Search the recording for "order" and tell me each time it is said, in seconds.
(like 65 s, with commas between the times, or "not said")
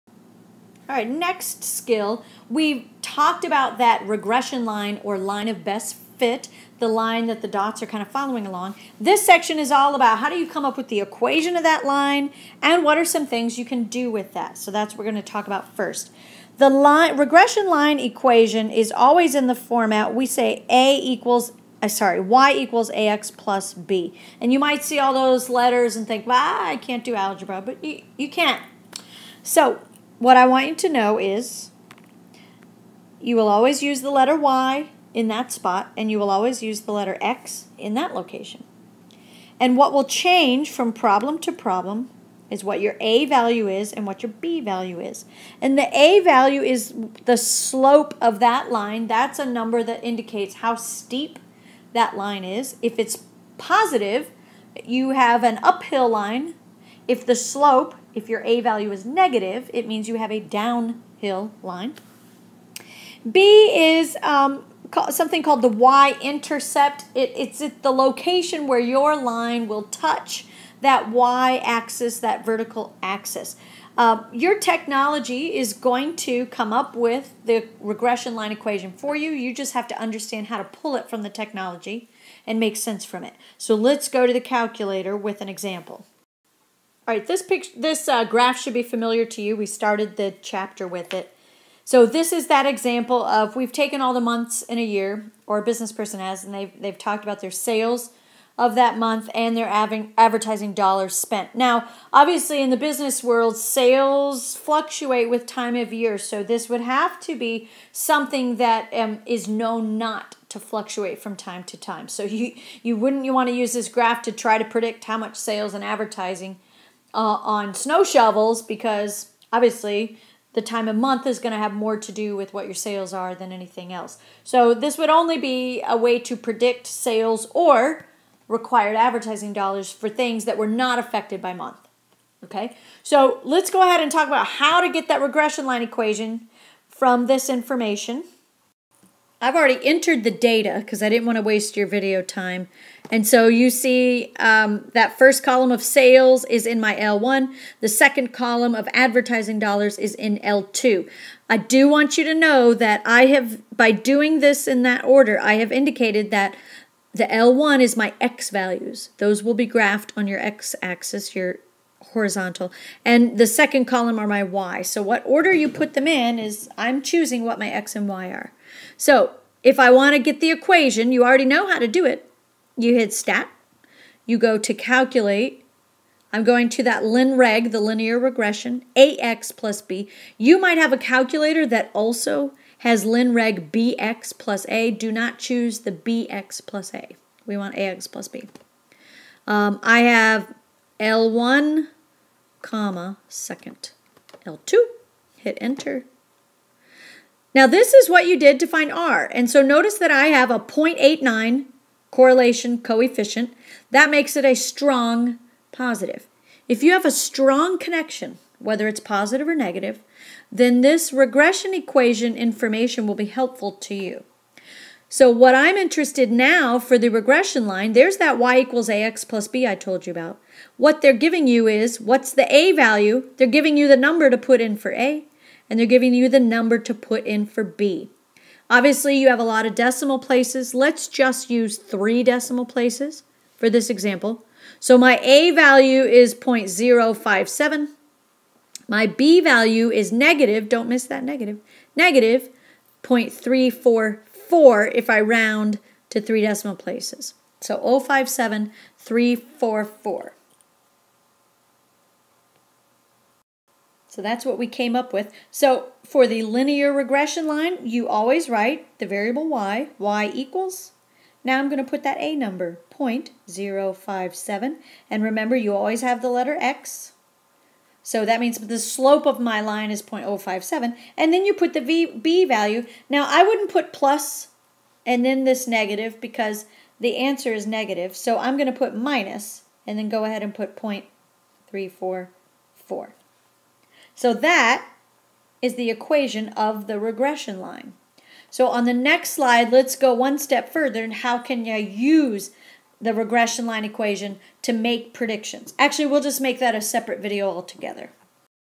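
155 s, 165 s.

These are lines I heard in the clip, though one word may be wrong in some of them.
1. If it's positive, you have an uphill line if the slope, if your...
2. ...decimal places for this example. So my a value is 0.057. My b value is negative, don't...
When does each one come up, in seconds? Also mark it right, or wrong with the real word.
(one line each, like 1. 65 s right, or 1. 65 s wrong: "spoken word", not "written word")
1. 52 s right
2. 232 s right.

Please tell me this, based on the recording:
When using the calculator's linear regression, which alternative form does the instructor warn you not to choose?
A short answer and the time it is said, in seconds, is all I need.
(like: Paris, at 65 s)
linreg bx plus a, at 183 s.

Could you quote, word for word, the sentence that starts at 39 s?
And what will change from problem to problem is what your A value is and what your B value is.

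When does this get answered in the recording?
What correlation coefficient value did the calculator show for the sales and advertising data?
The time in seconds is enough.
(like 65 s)
200 s.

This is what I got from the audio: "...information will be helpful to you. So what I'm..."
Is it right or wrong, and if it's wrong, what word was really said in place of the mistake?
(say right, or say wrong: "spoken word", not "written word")
right.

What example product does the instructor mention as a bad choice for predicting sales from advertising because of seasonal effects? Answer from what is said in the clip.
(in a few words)
snow shovels.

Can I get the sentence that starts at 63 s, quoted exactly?
B is um, something called the y-intercept.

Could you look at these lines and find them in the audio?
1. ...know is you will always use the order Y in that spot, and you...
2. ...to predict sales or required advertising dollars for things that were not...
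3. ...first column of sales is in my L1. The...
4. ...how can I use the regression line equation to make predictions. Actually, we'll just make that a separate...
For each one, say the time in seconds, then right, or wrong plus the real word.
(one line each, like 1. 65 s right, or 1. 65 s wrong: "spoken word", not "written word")
1. 30 s wrong: "letter", not "order"
2. 126 s right
3. 145 s right
4. 291 s right.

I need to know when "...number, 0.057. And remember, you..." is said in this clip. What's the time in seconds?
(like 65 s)
262 s.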